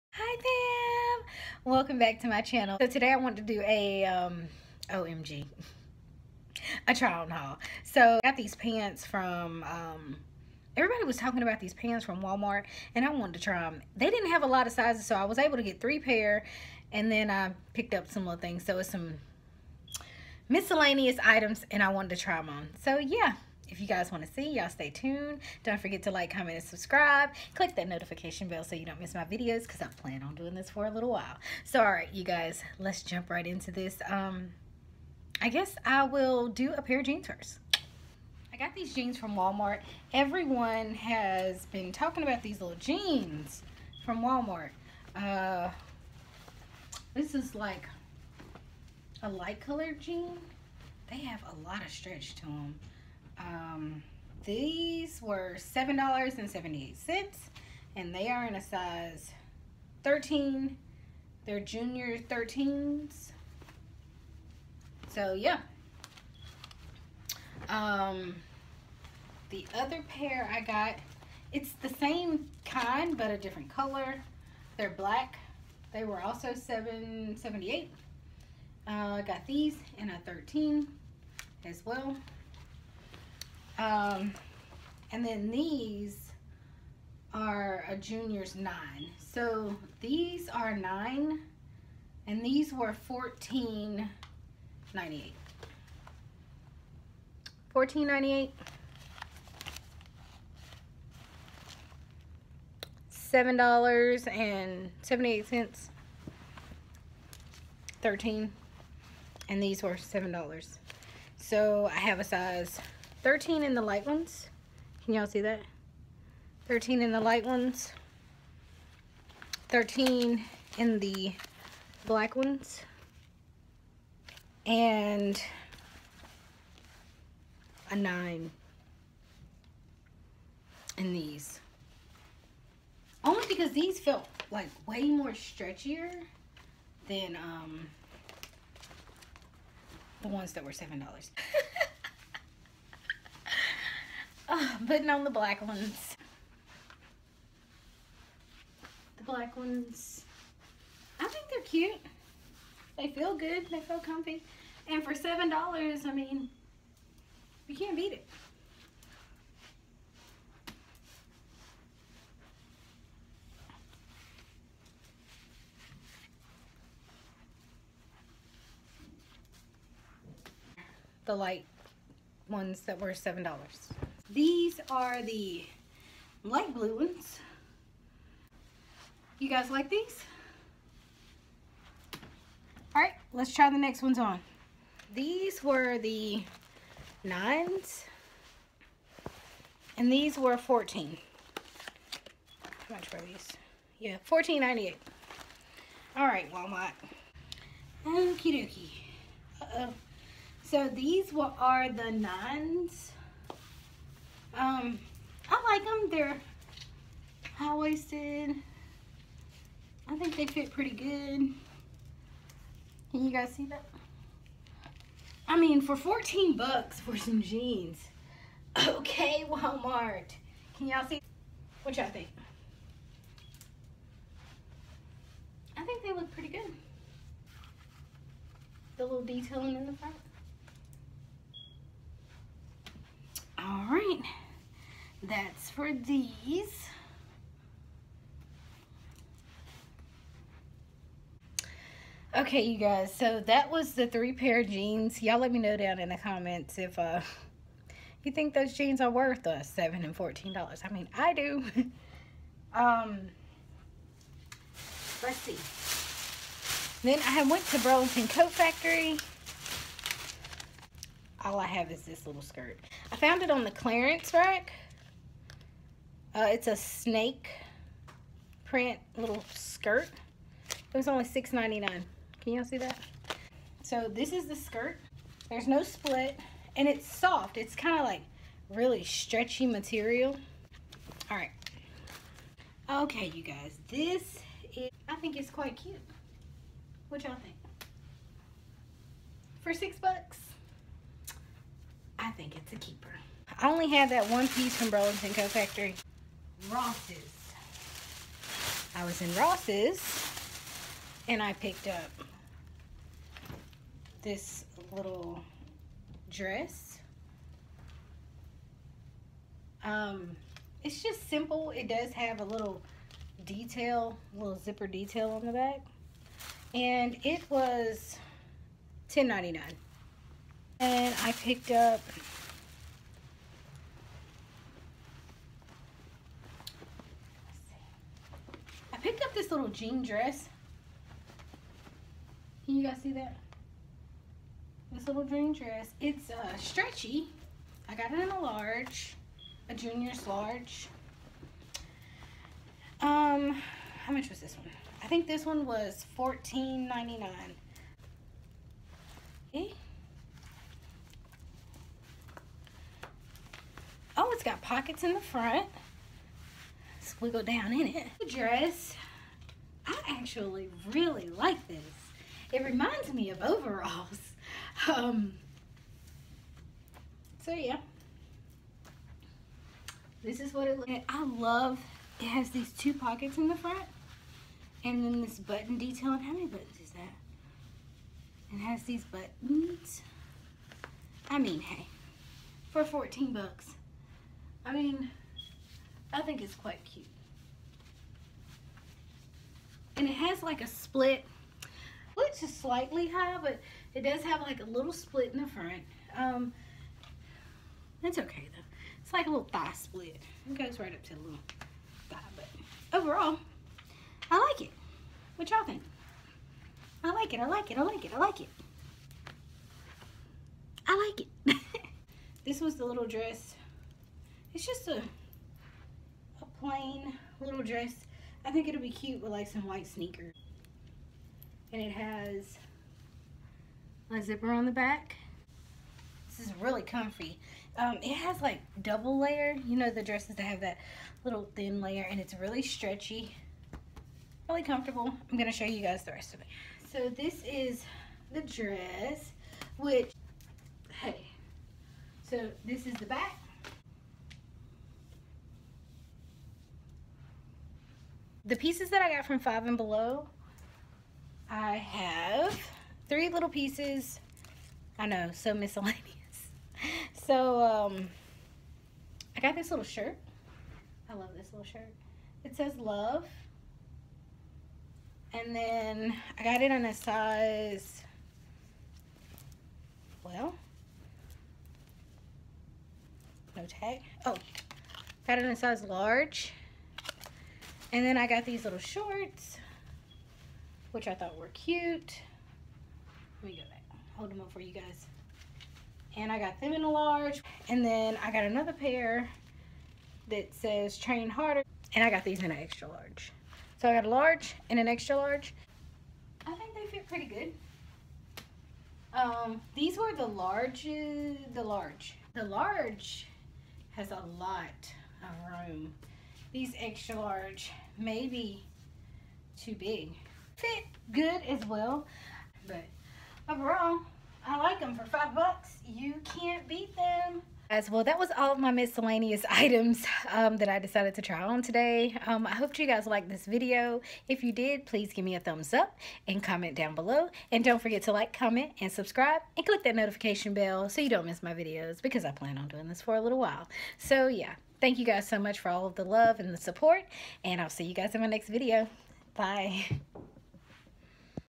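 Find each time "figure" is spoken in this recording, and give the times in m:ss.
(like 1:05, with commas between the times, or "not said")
not said.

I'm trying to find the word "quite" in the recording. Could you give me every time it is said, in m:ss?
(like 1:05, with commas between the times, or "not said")
4:45, 6:26.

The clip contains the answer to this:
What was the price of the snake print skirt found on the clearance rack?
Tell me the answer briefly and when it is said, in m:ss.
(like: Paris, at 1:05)
$6.99, at 4:31.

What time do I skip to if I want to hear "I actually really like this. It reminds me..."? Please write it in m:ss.
5:59.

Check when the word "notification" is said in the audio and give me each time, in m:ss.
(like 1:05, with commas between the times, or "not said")
0:27, 8:49.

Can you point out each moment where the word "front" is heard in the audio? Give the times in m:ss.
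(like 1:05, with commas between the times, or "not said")
3:49, 5:55, 6:13, 6:35.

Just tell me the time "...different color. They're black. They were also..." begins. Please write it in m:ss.
1:13.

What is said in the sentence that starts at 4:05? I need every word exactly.
Y'all let me know down in the comments if uh, you think those jeans are worth uh, 7 and $14.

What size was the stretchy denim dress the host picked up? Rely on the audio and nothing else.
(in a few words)
junior's large.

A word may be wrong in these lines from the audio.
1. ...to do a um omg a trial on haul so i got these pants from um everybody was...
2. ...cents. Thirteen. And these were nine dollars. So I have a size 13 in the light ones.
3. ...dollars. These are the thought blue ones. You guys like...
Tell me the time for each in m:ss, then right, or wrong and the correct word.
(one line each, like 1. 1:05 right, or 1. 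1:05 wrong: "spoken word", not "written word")
1. 0:03 right
2. 1:45 wrong: "seven", not "nine"
3. 2:53 wrong: "light", not "thought".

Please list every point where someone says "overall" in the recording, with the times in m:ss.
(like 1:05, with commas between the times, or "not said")
6:03, 6:42, 8:33.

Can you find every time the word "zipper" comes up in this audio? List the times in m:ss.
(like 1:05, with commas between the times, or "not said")
5:14, 7:04.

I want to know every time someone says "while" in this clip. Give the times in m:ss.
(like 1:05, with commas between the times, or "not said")
0:31, 8:53.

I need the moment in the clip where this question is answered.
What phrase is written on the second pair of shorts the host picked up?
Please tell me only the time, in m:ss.
8:10.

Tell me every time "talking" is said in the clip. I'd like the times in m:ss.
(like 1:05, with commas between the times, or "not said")
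0:11, 0:41.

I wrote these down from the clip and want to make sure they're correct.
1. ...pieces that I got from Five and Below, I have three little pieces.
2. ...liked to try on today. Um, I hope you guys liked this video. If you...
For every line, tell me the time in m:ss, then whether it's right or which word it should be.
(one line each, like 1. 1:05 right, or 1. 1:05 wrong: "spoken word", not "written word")
1. 7:28 right
2. 8:40 wrong: "decided", not "liked".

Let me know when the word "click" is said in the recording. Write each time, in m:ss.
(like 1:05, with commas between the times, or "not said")
0:27, 8:49.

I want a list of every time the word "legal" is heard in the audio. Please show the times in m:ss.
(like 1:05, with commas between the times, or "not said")
not said.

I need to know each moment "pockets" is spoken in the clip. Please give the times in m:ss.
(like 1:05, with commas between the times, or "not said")
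5:54, 6:12.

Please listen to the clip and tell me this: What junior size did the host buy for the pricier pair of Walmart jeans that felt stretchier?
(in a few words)
9.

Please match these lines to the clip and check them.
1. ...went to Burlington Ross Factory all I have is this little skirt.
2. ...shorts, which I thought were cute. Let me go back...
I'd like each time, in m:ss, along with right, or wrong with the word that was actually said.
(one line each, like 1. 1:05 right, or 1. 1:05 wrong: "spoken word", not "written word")
1. 4:17 wrong: "Coat", not "Ross"
2. 7:58 right.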